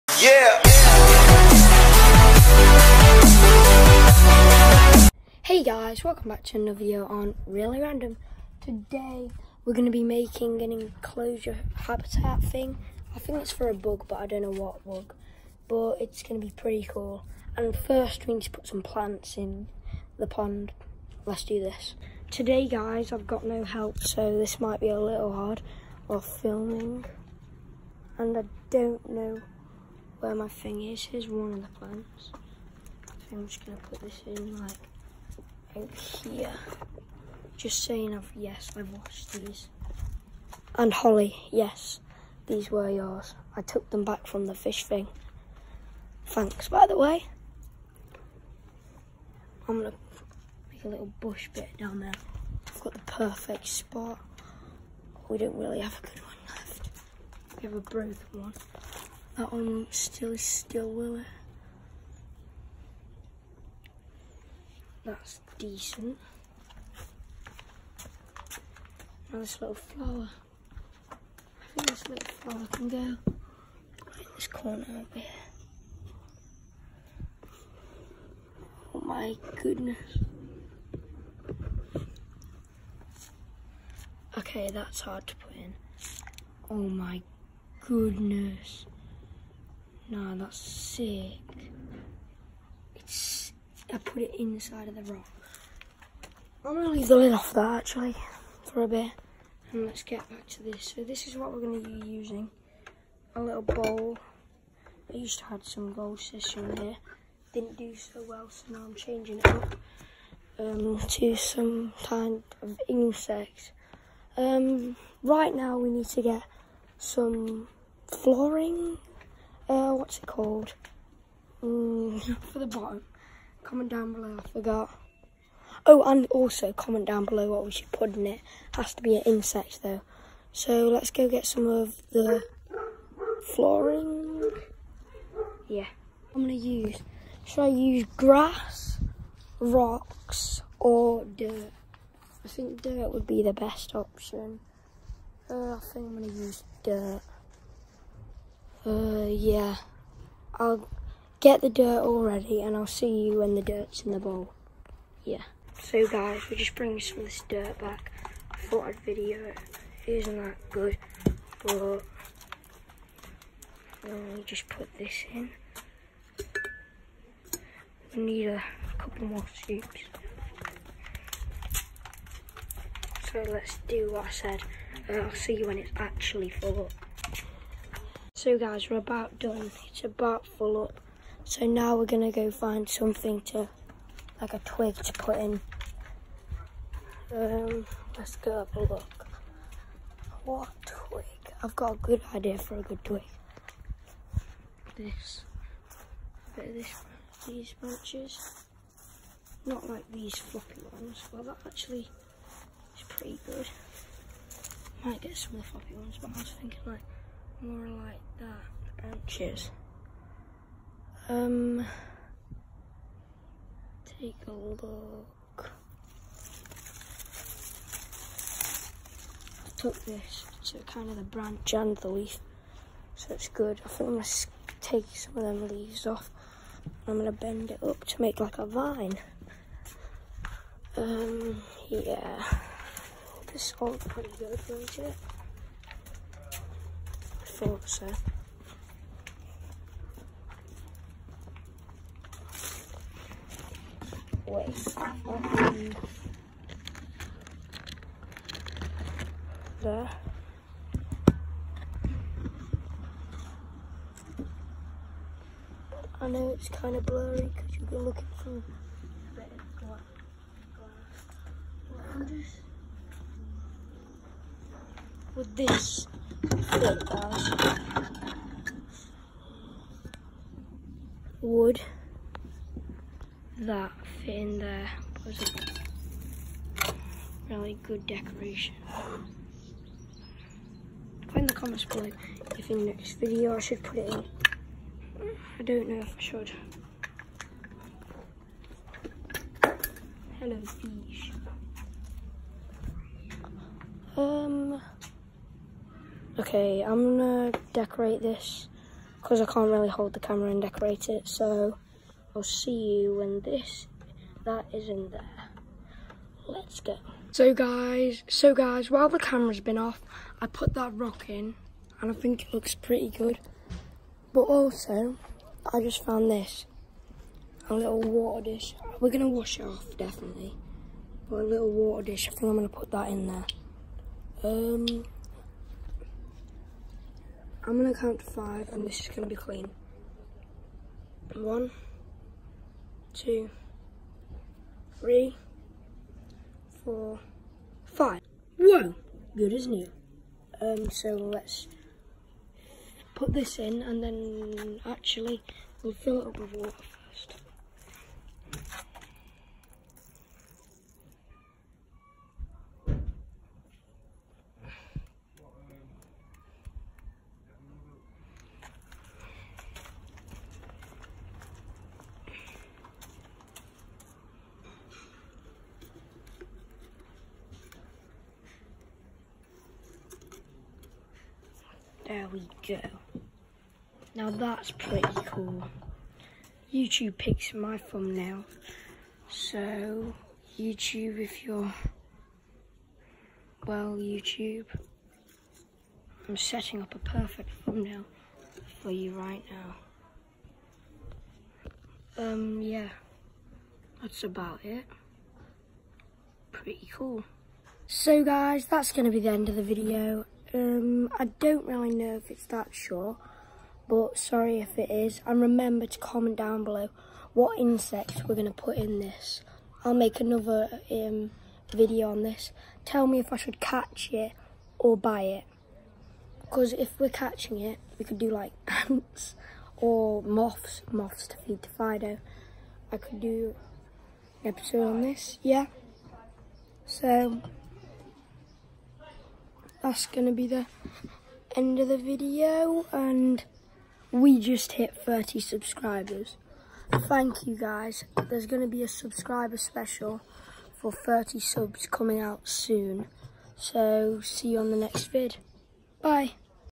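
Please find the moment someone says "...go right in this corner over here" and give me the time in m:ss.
1:12.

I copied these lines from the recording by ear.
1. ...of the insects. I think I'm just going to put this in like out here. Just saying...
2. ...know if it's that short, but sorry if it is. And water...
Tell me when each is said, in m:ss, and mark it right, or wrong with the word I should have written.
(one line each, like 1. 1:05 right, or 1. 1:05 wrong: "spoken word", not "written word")
1. 0:31 wrong: "plants", not "insects"
2. 6:41 wrong: "remember", not "water".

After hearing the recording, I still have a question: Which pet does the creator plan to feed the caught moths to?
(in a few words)
Fido.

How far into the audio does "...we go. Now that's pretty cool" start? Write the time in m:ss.
6:12.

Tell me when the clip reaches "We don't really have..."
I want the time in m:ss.
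0:55.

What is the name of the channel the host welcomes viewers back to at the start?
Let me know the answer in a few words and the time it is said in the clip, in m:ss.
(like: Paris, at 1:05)
Really Random, at 0:07.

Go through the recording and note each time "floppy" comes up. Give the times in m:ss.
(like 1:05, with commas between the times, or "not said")
3:20, 3:25.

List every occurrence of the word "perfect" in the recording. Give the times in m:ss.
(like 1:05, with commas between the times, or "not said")
0:52, 6:26.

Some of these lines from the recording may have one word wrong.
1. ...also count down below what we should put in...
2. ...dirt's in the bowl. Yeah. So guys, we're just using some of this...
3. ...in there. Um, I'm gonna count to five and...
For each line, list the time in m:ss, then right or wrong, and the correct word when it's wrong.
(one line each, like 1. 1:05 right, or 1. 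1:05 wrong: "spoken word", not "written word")
1. 2:06 wrong: "comment", not "count"
2. 2:33 wrong: "bringing", not "using"
3. 5:23 right.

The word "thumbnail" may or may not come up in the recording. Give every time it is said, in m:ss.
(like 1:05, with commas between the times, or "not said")
6:17, 6:27.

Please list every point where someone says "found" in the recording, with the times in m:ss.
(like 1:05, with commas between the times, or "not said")
5:16.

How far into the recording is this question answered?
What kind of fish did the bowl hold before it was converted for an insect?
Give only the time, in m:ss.
1:45.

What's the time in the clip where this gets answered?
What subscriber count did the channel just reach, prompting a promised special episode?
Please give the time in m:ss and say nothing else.
7:15.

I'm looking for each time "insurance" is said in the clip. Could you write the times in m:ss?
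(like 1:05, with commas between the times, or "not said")
not said.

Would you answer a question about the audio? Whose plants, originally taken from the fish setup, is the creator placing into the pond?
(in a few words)
Holly.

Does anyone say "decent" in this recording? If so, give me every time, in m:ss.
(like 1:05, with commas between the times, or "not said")
1:05.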